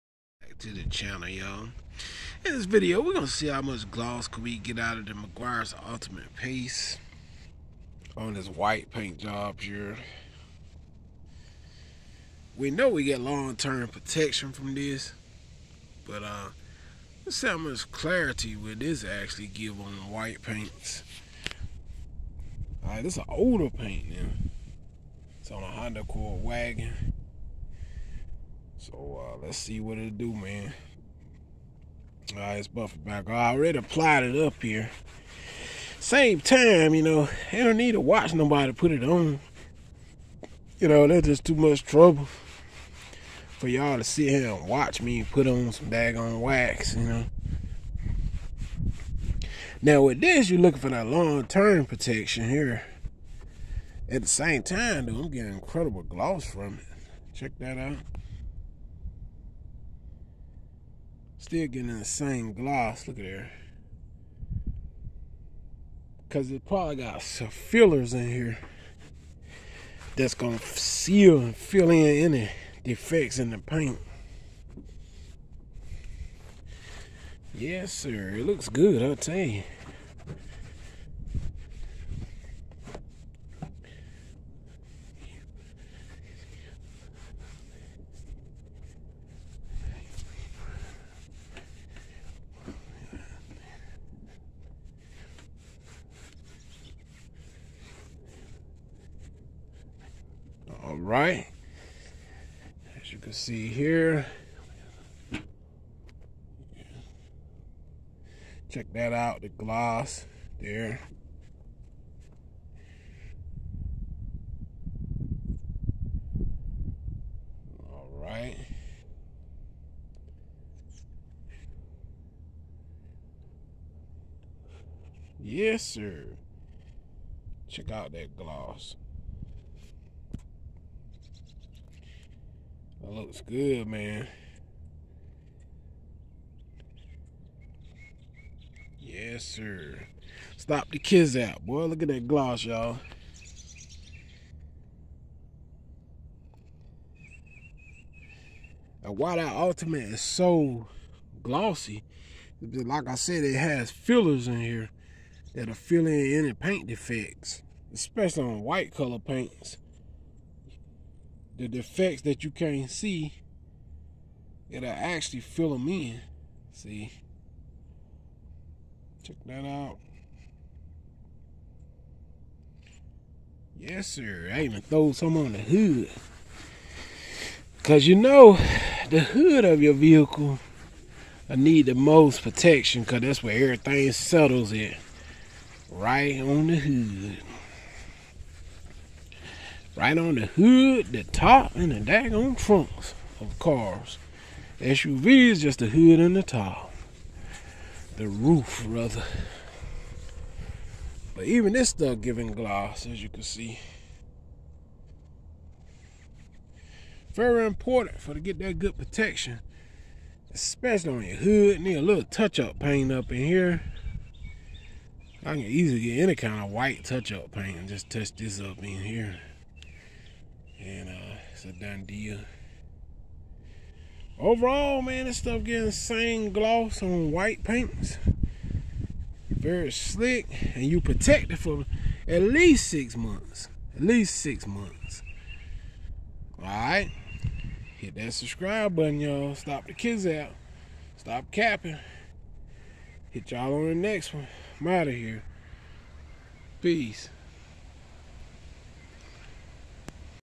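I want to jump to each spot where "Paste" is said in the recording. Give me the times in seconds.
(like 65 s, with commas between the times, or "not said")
6 s.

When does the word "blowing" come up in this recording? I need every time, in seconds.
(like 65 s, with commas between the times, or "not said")
not said.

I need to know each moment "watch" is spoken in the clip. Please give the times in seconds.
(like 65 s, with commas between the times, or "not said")
37 s, 44 s.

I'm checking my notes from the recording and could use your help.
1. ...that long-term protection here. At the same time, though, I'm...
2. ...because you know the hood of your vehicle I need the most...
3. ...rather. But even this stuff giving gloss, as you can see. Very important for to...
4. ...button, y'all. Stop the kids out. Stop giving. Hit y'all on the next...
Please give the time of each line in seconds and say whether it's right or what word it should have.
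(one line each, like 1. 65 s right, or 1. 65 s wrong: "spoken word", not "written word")
1. 50 s right
2. 177 s right
3. 198 s right
4. 238 s wrong: "capping", not "giving".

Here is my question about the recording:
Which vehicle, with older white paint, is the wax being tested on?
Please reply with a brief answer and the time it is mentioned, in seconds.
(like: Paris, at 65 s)
Honda Accord wagon, at 25 s.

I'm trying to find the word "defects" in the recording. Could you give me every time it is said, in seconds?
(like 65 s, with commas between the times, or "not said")
72 s, 156 s, 161 s.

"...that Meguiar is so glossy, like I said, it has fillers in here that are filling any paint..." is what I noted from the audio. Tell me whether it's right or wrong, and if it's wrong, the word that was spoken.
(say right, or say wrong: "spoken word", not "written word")
wrong: "Ultimate", not "Meguiar".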